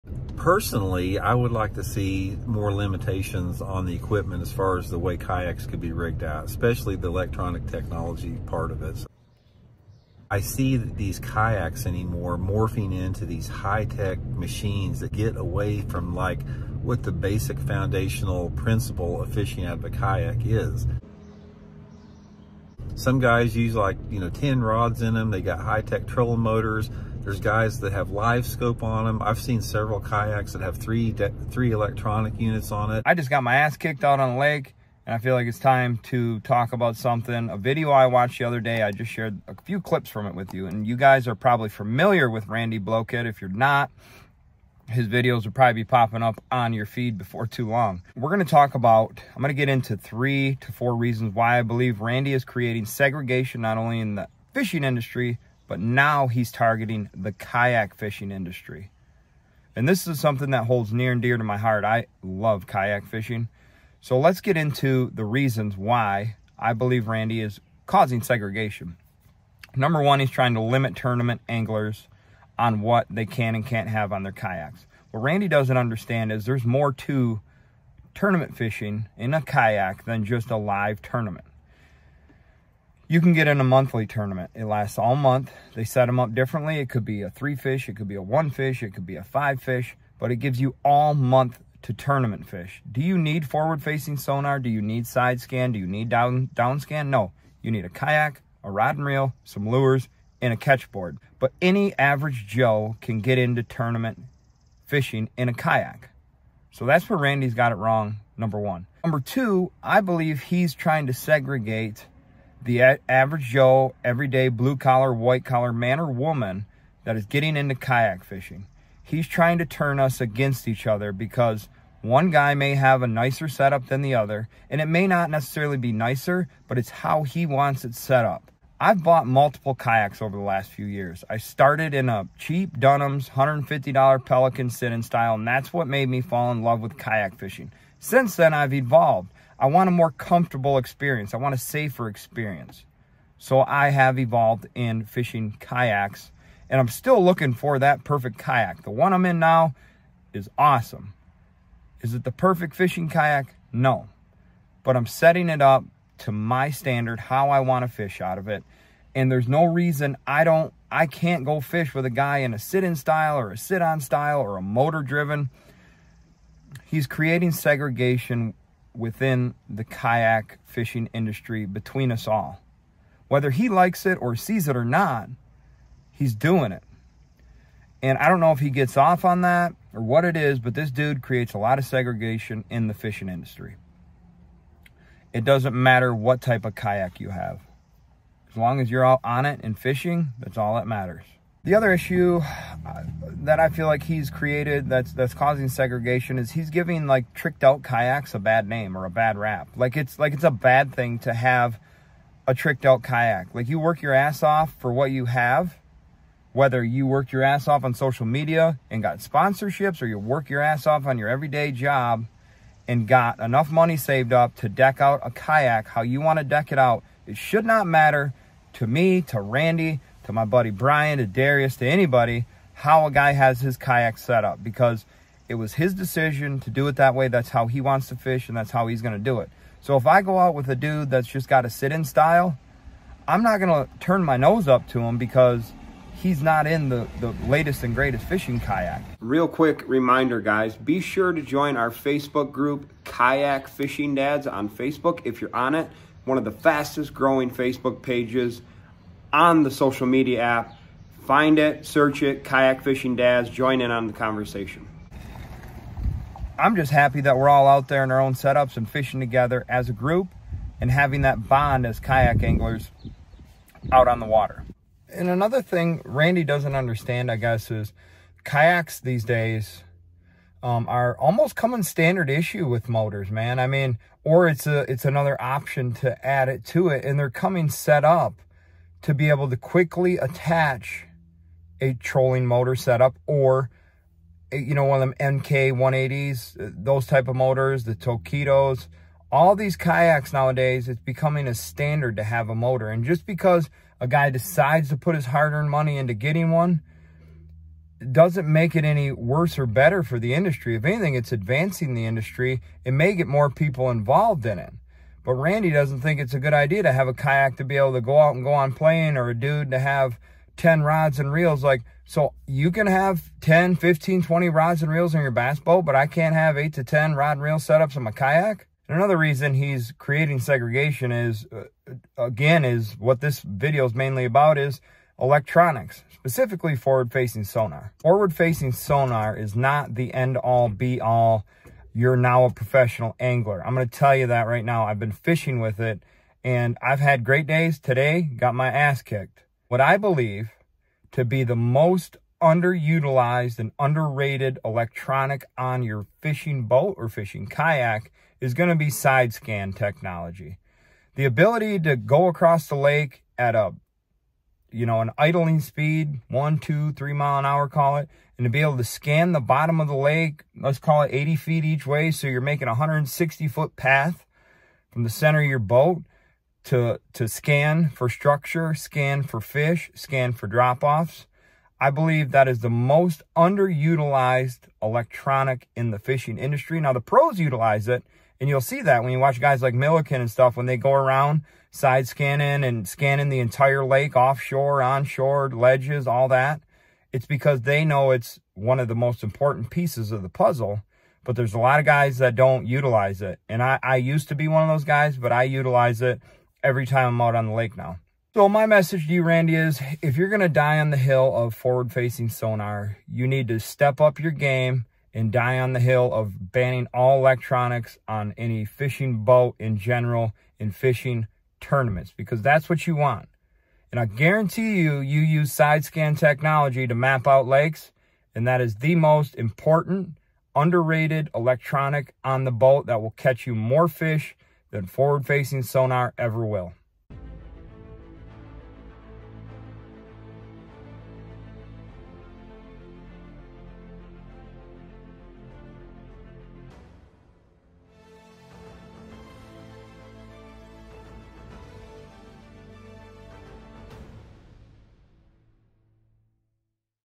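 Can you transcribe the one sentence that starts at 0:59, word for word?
And this is something that holds near and dear to my heart.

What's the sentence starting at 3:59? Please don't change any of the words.
Real quick reminder, guys, be sure to join our Facebook group, Kayak Fishing Dads on Facebook if you're on it.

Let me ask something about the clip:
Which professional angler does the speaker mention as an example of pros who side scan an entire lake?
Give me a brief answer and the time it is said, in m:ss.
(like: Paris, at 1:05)
Milliken, at 6:19.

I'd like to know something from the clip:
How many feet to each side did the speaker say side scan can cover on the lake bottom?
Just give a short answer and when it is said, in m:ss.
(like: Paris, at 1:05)
80 feet, at 6:01.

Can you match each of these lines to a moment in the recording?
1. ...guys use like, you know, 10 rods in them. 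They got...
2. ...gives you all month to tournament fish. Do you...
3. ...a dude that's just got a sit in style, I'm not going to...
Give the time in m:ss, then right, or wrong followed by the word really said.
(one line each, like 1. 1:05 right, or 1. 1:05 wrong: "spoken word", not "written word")
1. 0:23 right
2. 1:30 right
3. 3:50 right.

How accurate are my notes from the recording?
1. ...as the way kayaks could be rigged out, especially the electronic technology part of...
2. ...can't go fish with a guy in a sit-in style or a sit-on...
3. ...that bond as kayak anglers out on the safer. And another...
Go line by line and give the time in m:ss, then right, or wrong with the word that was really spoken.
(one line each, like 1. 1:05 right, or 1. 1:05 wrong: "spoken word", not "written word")
1. 0:04 right
2. 2:41 right
3. 4:21 wrong: "water", not "safer".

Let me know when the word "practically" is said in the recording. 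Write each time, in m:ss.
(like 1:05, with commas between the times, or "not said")
not said.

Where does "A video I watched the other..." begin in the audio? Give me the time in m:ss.
0:37.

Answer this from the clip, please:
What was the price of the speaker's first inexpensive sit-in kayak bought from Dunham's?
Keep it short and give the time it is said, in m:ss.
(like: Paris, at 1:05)
$150, at 2:13.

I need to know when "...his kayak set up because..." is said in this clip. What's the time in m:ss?
3:43.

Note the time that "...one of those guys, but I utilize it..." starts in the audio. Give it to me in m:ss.
6:34.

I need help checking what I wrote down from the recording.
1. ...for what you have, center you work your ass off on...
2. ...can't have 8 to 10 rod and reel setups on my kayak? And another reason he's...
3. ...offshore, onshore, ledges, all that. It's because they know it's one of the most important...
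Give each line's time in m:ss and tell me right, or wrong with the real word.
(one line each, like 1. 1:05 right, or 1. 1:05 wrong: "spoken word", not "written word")
1. 3:24 wrong: "whether", not "center"
2. 5:16 right
3. 6:24 right.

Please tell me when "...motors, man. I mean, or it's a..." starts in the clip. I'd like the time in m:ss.
4:32.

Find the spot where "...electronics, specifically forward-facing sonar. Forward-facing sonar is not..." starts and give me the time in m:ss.
5:25.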